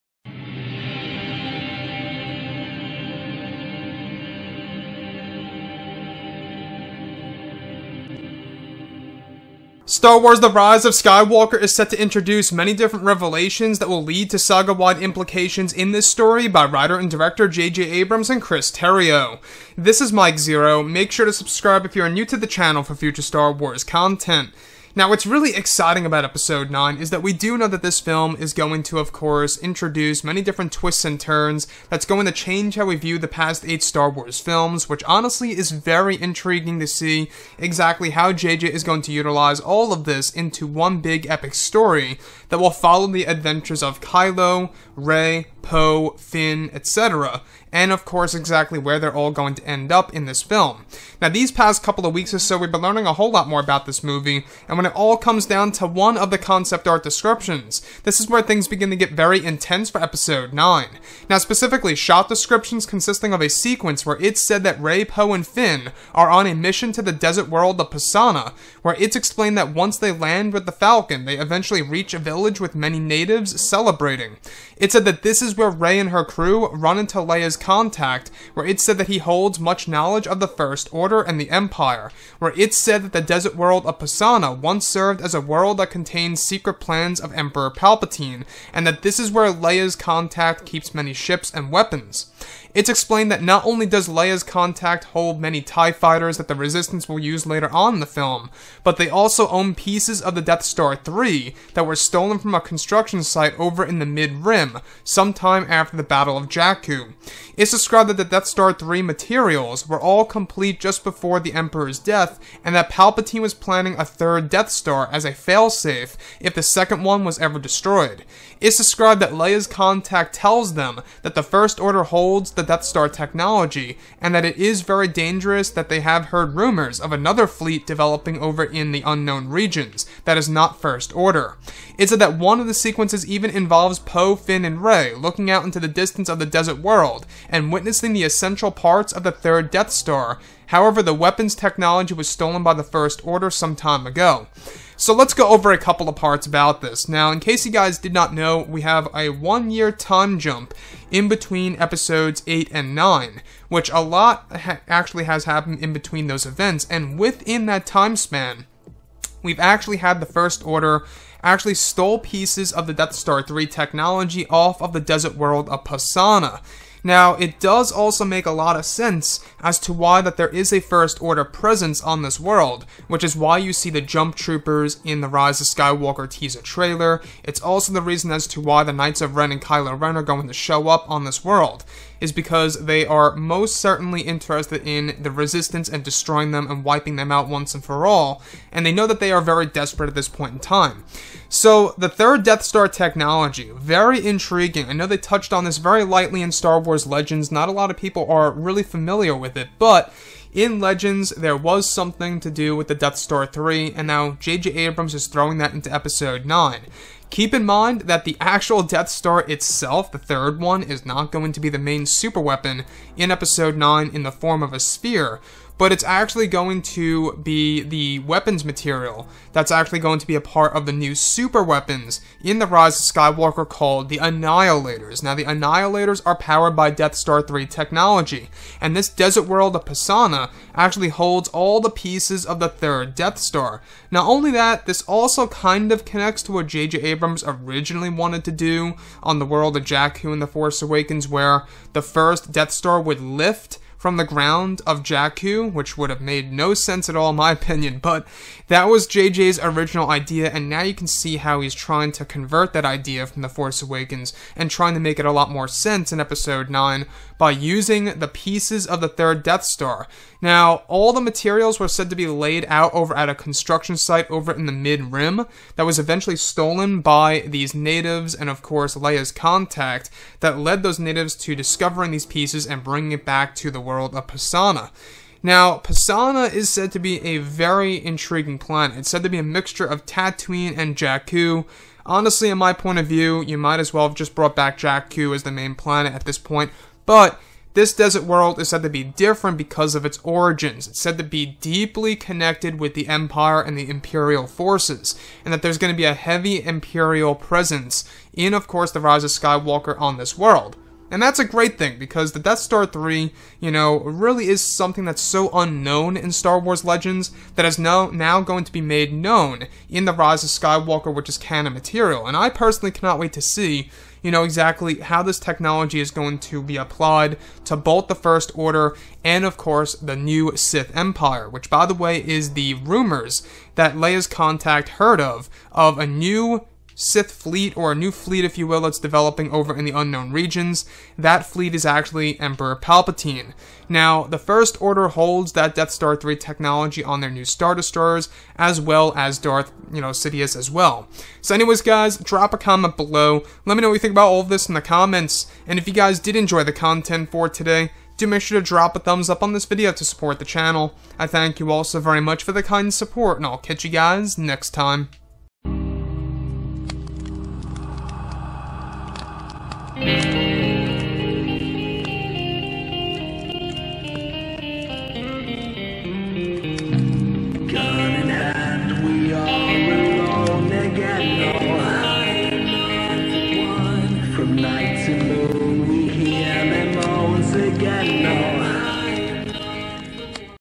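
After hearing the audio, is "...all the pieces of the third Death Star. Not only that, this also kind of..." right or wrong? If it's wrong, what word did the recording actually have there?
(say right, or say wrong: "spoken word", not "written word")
right.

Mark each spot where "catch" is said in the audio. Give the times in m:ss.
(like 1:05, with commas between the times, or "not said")
5:53.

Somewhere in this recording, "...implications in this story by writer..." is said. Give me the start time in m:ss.
0:15.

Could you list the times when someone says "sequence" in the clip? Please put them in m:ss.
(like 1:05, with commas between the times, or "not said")
1:03, 2:12.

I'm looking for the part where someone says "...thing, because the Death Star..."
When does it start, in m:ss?
5:01.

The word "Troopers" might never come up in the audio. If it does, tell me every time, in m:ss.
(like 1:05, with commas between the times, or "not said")
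2:54.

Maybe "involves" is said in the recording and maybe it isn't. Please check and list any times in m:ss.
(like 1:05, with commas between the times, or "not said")
2:13.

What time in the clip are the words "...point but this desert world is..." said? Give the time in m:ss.
4:46.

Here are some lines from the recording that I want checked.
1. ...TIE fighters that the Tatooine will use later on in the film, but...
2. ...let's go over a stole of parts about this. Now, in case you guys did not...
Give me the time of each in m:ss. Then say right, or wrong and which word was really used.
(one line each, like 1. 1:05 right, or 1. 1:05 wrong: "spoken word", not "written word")
1. 1:35 wrong: "Resistance", not "Tatooine"
2. 2:25 wrong: "couple", not "stole".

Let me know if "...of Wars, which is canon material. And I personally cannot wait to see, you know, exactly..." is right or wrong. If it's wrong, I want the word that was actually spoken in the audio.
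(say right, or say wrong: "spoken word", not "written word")
wrong: "Skywalker", not "Wars".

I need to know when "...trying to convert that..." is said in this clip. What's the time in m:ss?
4:11.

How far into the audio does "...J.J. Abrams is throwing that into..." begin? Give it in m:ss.
3:24.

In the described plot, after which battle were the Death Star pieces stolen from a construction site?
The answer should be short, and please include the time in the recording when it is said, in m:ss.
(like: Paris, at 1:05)
Battle of Jakku, at 1:46.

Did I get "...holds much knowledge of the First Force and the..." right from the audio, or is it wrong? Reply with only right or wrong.
wrong.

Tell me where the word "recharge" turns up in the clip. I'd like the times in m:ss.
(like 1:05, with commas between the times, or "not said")
not said.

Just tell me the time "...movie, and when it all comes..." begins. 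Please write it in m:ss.
0:54.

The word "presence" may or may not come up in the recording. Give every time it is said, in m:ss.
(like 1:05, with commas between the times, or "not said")
2:51, 4:57.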